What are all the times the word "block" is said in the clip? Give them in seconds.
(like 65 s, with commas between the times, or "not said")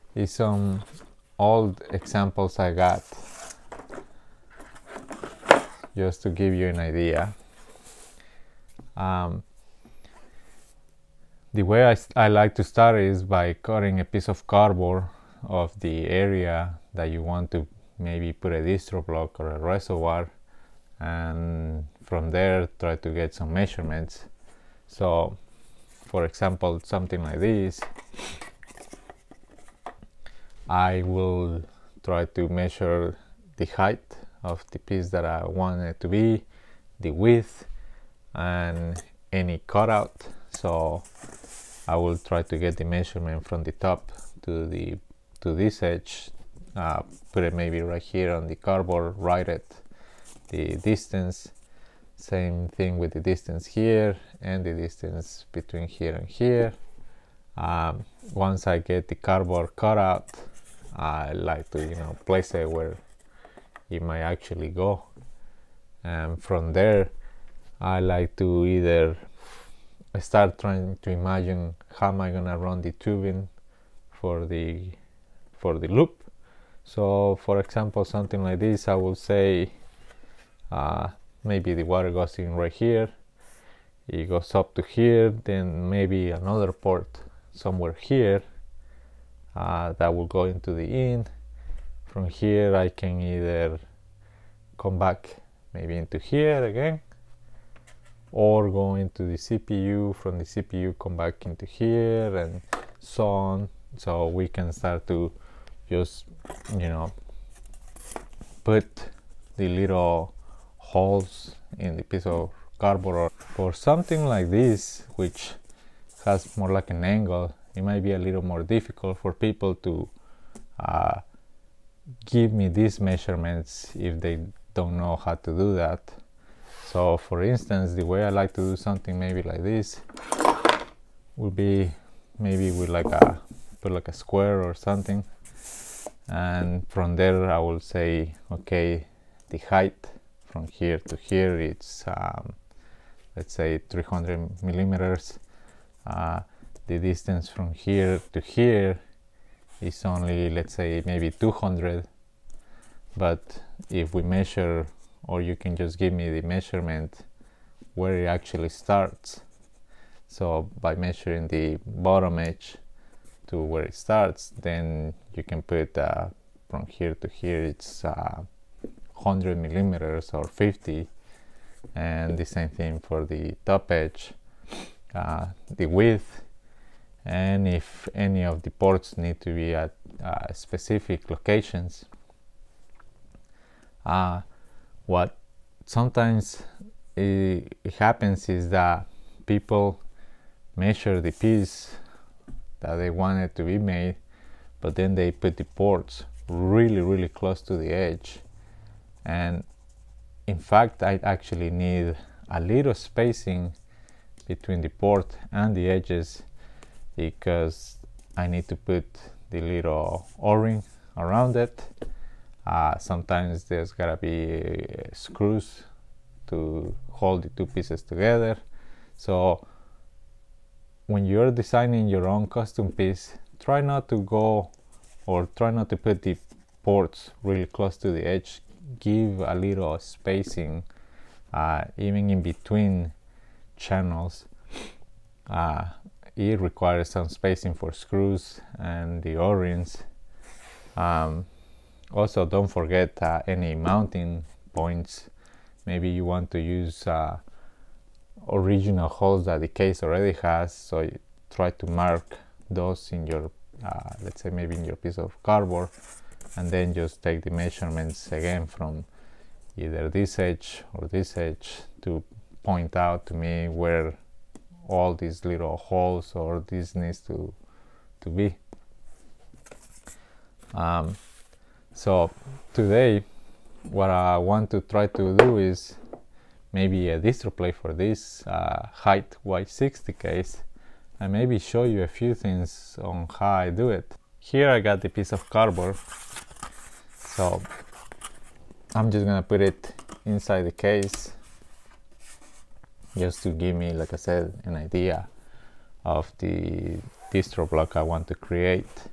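19 s, 297 s.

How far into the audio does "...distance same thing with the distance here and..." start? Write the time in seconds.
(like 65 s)
50 s.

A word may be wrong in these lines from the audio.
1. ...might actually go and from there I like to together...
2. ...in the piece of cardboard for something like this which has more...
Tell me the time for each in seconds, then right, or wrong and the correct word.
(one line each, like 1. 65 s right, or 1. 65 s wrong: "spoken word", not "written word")
1. 64 s wrong: "either", not "together"
2. 111 s right.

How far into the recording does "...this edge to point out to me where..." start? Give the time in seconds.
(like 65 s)
261 s.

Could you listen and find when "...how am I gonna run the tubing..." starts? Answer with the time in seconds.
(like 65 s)
71 s.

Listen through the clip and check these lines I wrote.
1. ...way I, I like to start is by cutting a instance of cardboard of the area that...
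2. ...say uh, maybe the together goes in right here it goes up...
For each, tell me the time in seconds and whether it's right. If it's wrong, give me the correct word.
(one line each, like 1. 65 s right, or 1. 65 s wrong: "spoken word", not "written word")
1. 11 s wrong: "piece", not "instance"
2. 79 s wrong: "water", not "together".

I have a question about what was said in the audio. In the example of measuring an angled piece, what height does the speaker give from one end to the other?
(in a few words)
300 millimeters.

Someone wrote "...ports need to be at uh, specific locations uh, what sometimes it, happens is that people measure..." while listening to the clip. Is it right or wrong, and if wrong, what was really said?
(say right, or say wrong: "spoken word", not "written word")
right.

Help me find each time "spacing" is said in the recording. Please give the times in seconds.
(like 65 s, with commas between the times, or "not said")
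202 s, 229 s, 237 s.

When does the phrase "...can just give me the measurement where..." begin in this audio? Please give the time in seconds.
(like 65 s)
155 s.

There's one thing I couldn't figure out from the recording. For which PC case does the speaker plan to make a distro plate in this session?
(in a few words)
HYTE Y60.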